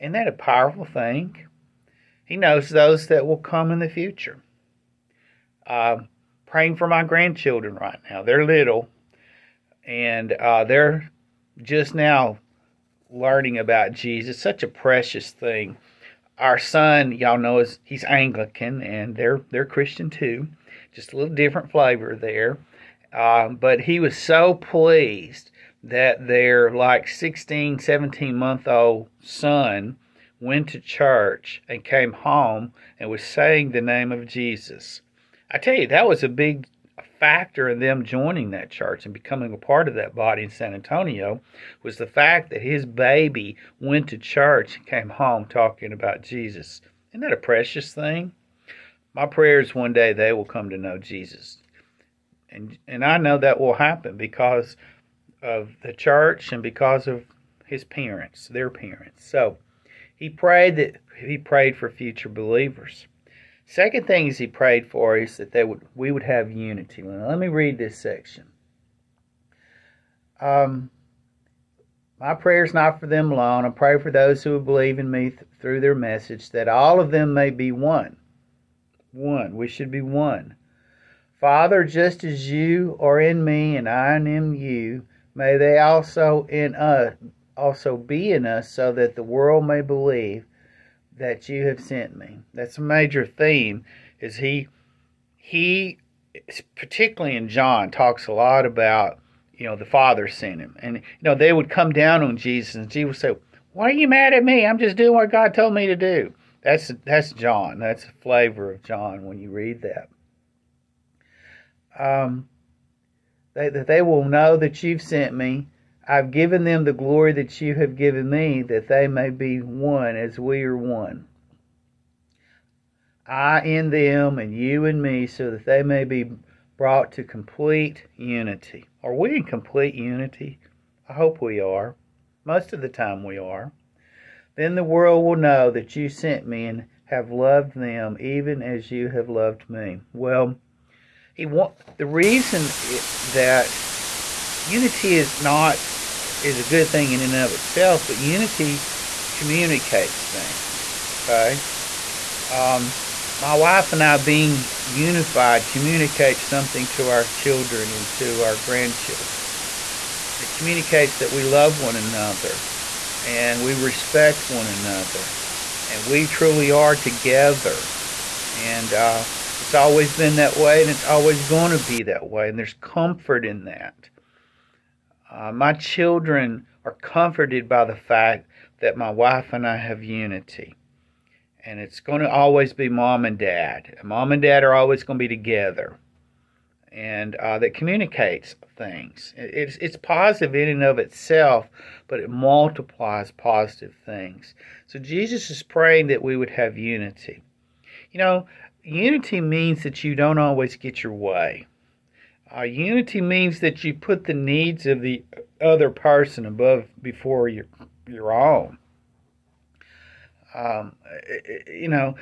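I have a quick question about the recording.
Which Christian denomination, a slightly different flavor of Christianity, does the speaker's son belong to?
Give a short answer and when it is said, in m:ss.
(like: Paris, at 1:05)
Anglican, at 0:18.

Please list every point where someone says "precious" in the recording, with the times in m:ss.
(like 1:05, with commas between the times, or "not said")
0:14, 0:47.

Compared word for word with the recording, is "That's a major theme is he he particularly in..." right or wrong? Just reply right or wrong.
right.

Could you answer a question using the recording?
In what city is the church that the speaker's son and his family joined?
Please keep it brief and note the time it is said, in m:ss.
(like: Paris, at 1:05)
San Antonio, at 0:40.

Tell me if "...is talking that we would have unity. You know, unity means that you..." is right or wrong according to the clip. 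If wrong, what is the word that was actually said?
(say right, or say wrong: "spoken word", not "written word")
wrong: "praying", not "talking".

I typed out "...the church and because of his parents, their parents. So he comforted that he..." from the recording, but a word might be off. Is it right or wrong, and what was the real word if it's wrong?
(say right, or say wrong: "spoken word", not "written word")
wrong: "prayed", not "comforted".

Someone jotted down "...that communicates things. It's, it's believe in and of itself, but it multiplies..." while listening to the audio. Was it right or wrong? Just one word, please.
wrong.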